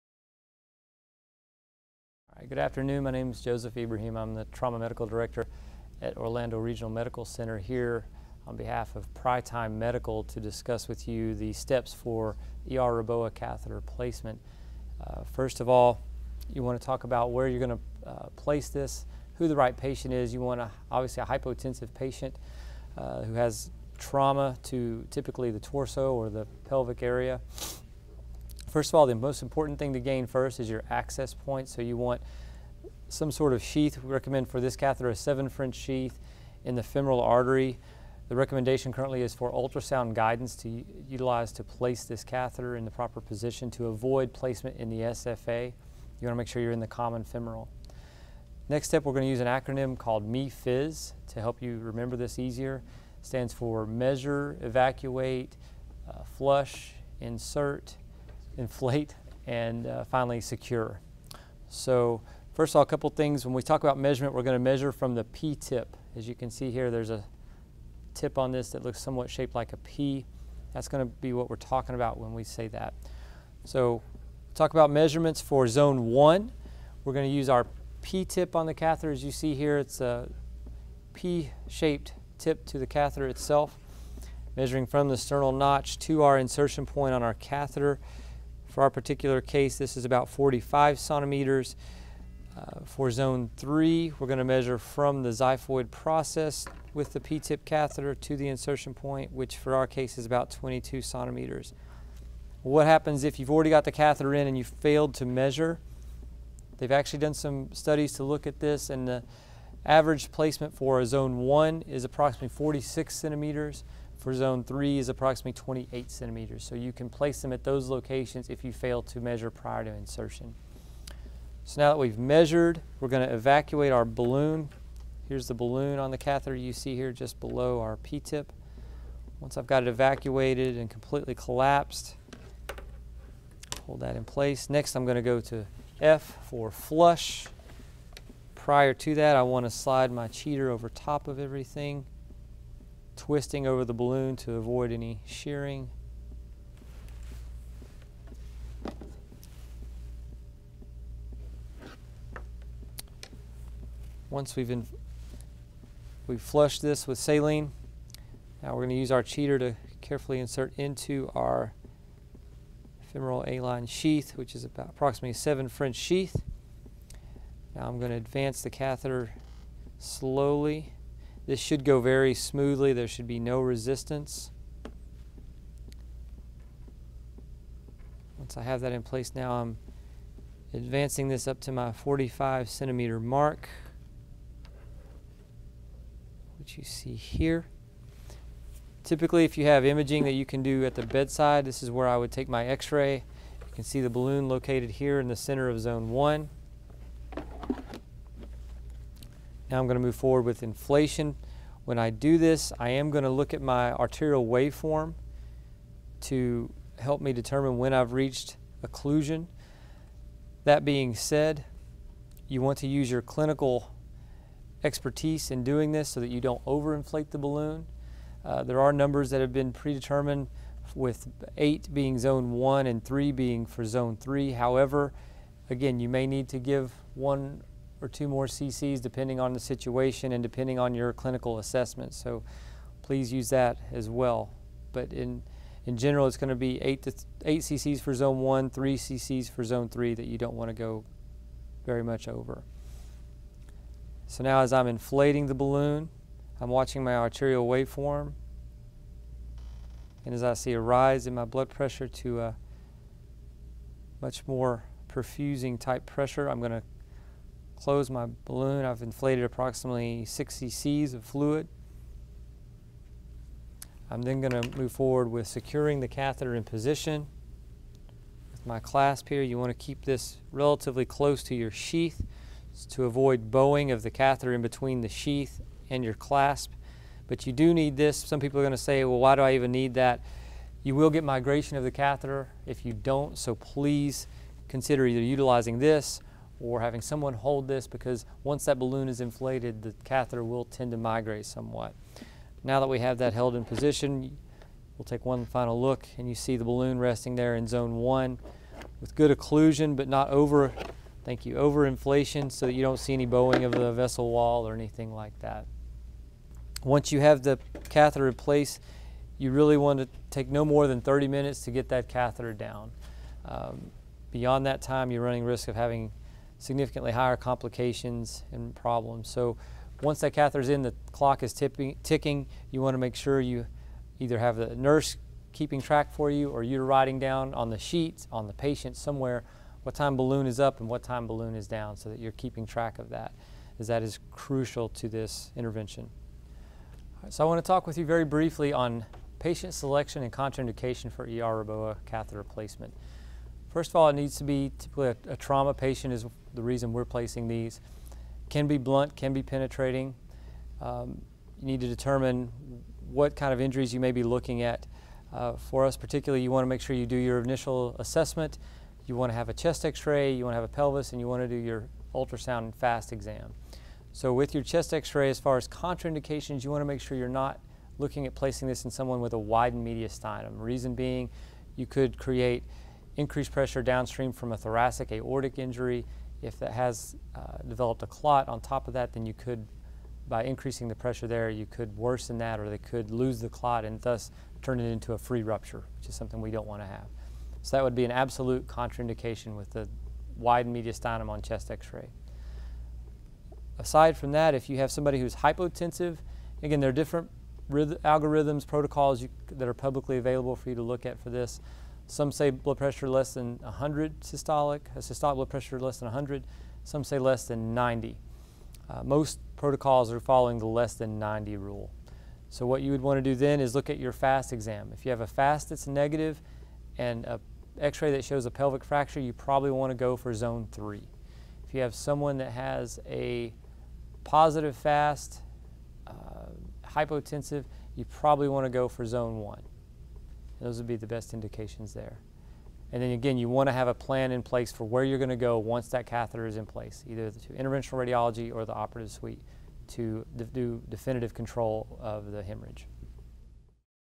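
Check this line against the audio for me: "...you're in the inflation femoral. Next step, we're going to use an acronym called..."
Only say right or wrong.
wrong.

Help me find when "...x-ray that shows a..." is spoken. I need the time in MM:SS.
06:57.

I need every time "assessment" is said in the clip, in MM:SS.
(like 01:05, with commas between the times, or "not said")
03:51, 05:57.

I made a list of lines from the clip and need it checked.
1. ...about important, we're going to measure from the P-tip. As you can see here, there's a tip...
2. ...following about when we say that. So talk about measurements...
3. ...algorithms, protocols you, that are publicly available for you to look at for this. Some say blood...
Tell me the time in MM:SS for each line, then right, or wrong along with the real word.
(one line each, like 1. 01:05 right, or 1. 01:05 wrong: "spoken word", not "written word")
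1. 01:03 wrong: "measurement", not "important"
2. 01:11 wrong: "talking", not "following"
3. 06:37 right.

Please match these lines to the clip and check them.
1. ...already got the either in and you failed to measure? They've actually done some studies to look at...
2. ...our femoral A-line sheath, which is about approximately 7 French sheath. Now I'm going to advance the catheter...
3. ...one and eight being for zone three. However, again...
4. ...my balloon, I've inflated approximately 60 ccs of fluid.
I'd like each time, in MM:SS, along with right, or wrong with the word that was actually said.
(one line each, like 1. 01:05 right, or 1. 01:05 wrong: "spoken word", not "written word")
1. 01:43 wrong: "catheter", not "either"
2. 02:41 right
3. 03:42 wrong: "three", not "eight"
4. 04:18 right.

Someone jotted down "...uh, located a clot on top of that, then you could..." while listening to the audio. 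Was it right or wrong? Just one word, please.
wrong.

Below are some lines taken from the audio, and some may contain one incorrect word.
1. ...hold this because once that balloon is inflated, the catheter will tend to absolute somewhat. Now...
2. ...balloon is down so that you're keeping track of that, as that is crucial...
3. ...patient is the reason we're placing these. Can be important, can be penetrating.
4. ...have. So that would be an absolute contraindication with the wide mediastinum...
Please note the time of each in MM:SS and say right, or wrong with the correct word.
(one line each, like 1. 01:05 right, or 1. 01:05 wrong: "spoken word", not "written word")
1. 04:47 wrong: "migrate", not "absolute"
2. 05:31 right
3. 05:45 wrong: "blunt", not "important"
4. 06:26 right.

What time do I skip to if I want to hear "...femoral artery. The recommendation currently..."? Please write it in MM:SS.
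00:36.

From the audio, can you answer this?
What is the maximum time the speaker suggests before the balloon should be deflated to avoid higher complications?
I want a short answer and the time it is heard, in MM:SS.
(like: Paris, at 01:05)
30 minutes, at 05:11.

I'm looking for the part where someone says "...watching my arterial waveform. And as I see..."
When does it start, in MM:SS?
04:06.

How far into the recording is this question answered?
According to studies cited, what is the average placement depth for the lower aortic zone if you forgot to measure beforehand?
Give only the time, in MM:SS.
01:55.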